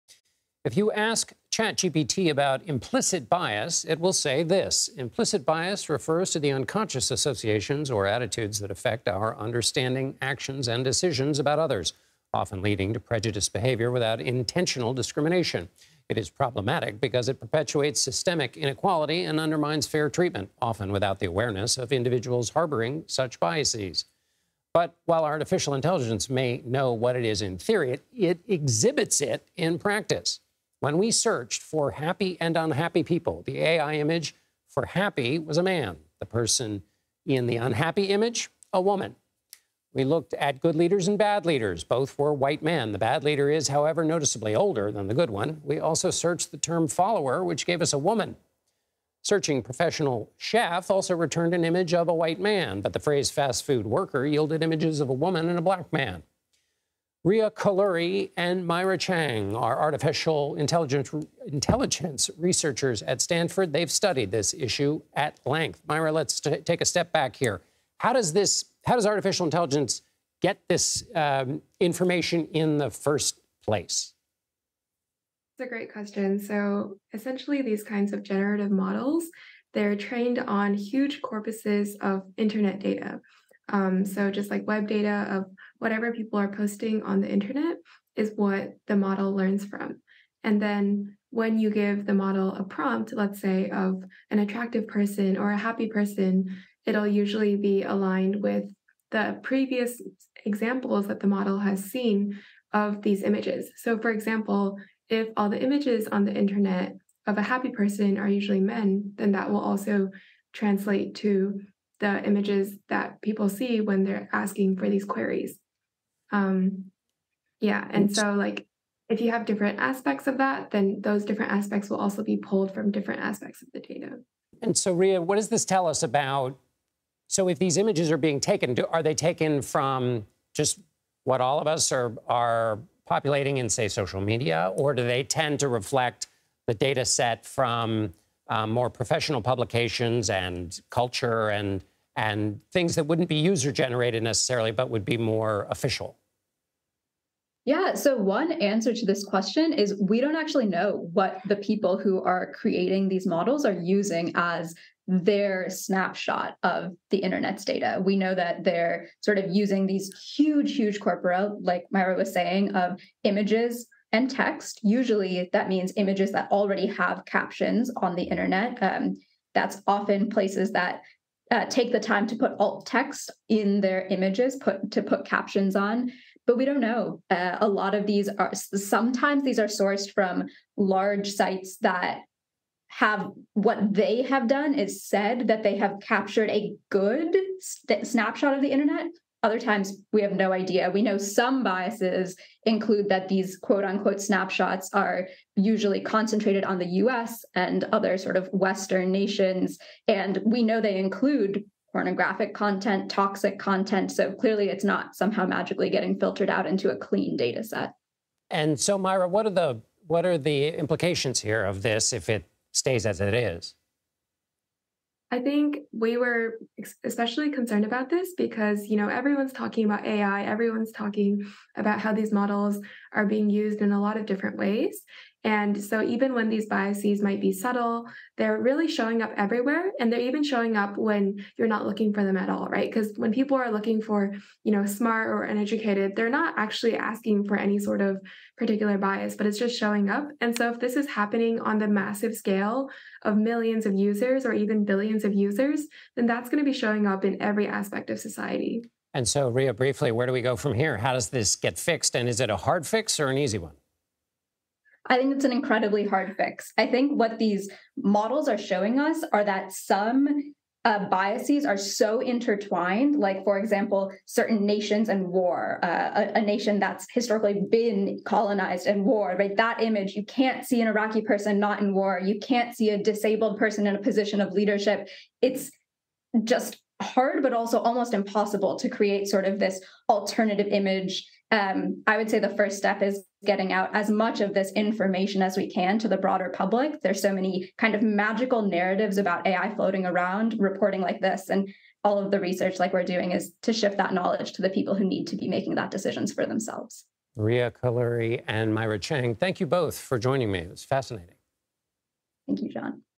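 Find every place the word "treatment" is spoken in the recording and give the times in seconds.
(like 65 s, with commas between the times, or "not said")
20 s.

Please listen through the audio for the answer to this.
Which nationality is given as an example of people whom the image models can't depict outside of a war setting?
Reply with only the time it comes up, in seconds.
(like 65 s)
270 s.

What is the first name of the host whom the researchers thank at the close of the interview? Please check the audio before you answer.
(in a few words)
John.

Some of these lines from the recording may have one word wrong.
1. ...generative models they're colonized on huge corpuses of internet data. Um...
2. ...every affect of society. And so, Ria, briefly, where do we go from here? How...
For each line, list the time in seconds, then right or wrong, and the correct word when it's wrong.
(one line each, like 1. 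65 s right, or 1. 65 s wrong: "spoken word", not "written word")
1. 78 s wrong: "trained", not "colonized"
2. 247 s wrong: "aspect", not "affect".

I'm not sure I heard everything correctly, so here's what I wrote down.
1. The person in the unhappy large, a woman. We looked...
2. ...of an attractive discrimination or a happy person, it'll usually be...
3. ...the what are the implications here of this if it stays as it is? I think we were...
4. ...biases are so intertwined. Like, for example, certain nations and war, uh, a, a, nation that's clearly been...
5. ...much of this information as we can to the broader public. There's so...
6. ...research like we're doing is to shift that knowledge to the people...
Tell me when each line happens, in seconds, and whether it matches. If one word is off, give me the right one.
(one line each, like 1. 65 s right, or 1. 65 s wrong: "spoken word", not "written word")
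1. 36 s wrong: "image", not "large"
2. 93 s wrong: "person", not "discrimination"
3. 209 s right
4. 261 s wrong: "historically", not "clearly"
5. 284 s right
6. 292 s right.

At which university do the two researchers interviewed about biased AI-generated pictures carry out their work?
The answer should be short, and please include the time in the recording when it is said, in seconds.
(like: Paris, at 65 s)
Stanford, at 63 s.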